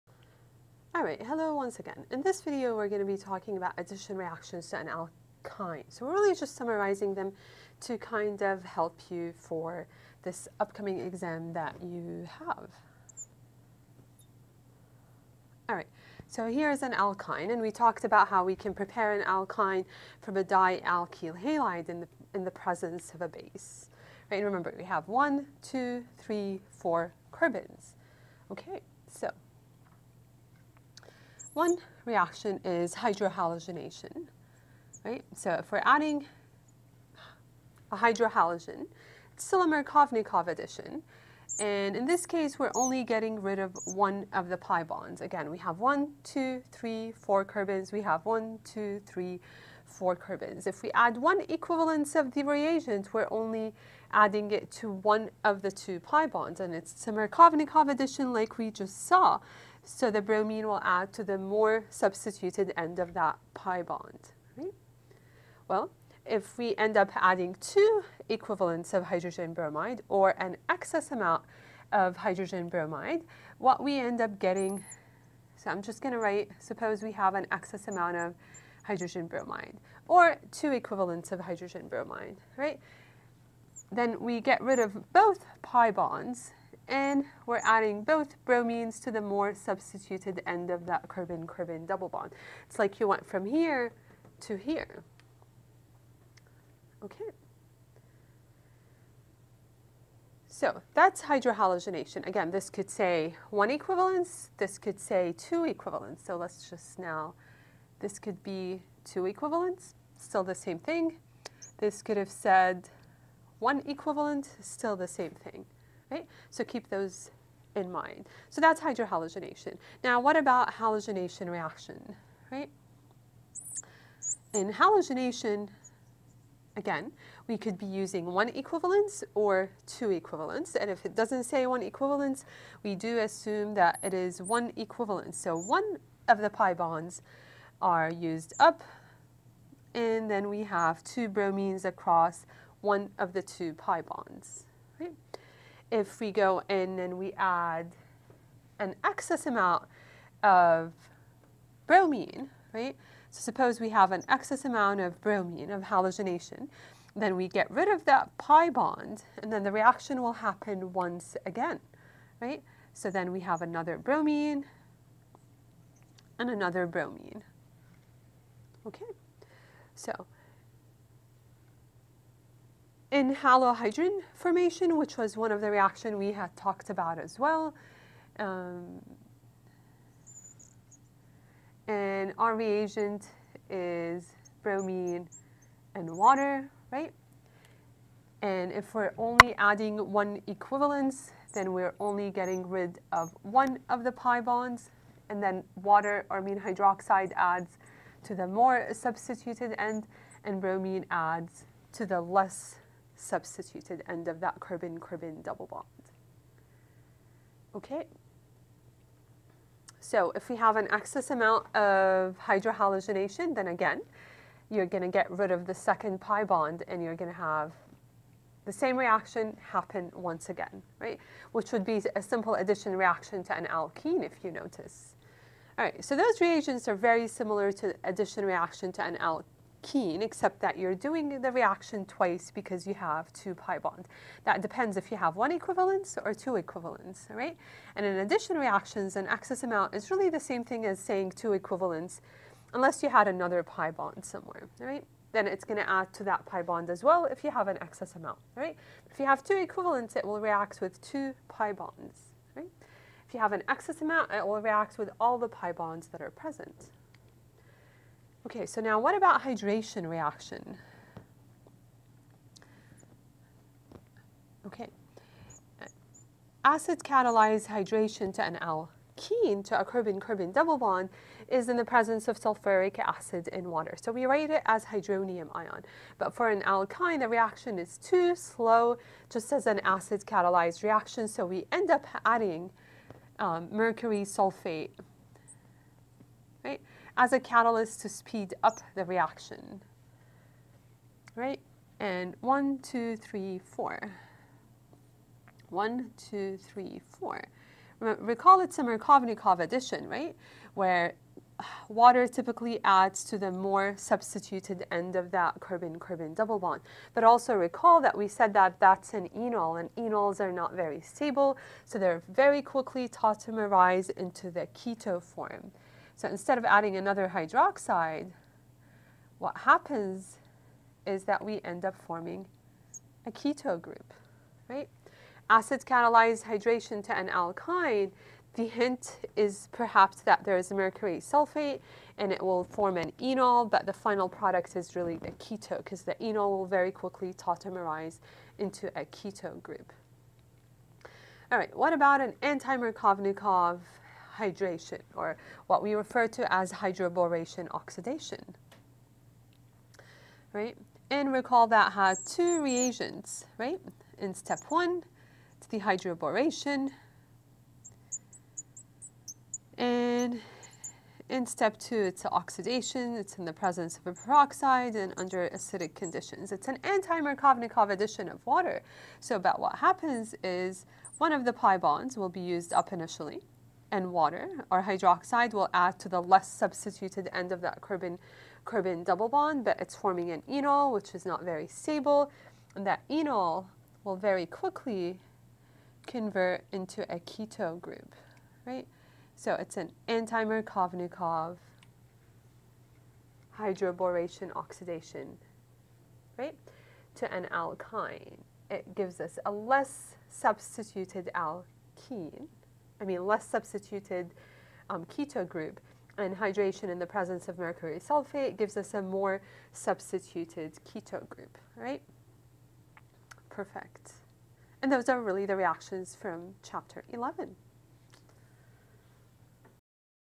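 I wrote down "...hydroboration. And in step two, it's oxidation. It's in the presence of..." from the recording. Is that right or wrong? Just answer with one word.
right.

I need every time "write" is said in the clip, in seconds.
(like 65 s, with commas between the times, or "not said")
76 s, 274 s.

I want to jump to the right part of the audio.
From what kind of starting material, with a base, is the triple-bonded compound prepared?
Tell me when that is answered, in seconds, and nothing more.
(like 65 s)
20 s.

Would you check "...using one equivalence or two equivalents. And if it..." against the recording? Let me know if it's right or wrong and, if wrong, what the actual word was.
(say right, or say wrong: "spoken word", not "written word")
right.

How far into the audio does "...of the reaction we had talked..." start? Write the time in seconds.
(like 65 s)
175 s.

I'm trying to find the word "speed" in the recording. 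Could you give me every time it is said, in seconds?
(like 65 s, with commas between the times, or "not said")
288 s.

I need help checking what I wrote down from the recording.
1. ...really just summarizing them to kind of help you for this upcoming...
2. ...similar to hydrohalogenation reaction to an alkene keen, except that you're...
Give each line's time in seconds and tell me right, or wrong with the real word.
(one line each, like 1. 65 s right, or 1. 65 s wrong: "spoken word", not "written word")
1. 6 s right
2. 227 s wrong: "addition", not "hydrohalogenation".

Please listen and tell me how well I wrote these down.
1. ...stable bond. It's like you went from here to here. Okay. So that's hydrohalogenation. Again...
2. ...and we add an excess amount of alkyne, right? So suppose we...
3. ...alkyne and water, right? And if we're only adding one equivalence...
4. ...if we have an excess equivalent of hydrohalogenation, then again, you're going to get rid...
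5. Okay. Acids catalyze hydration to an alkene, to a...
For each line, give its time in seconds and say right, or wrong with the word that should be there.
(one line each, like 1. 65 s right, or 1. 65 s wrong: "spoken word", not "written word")
1. 91 s wrong: "double", not "stable"
2. 146 s wrong: "bromine", not "alkyne"
3. 184 s wrong: "bromine", not "alkyne"
4. 210 s wrong: "amount", not "equivalent"
5. 264 s right.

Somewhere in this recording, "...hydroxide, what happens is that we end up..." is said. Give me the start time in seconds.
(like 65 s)
317 s.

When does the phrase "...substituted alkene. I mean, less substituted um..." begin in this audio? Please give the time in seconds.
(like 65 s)
400 s.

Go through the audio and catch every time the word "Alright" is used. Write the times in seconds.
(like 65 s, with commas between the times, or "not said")
1 s, 15 s.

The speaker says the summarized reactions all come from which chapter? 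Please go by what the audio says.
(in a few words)
chapter 11.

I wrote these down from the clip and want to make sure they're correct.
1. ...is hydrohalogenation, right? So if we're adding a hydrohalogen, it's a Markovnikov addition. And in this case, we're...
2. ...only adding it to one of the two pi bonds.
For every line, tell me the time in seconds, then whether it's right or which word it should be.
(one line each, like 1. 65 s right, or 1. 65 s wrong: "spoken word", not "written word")
1. 32 s right
2. 53 s right.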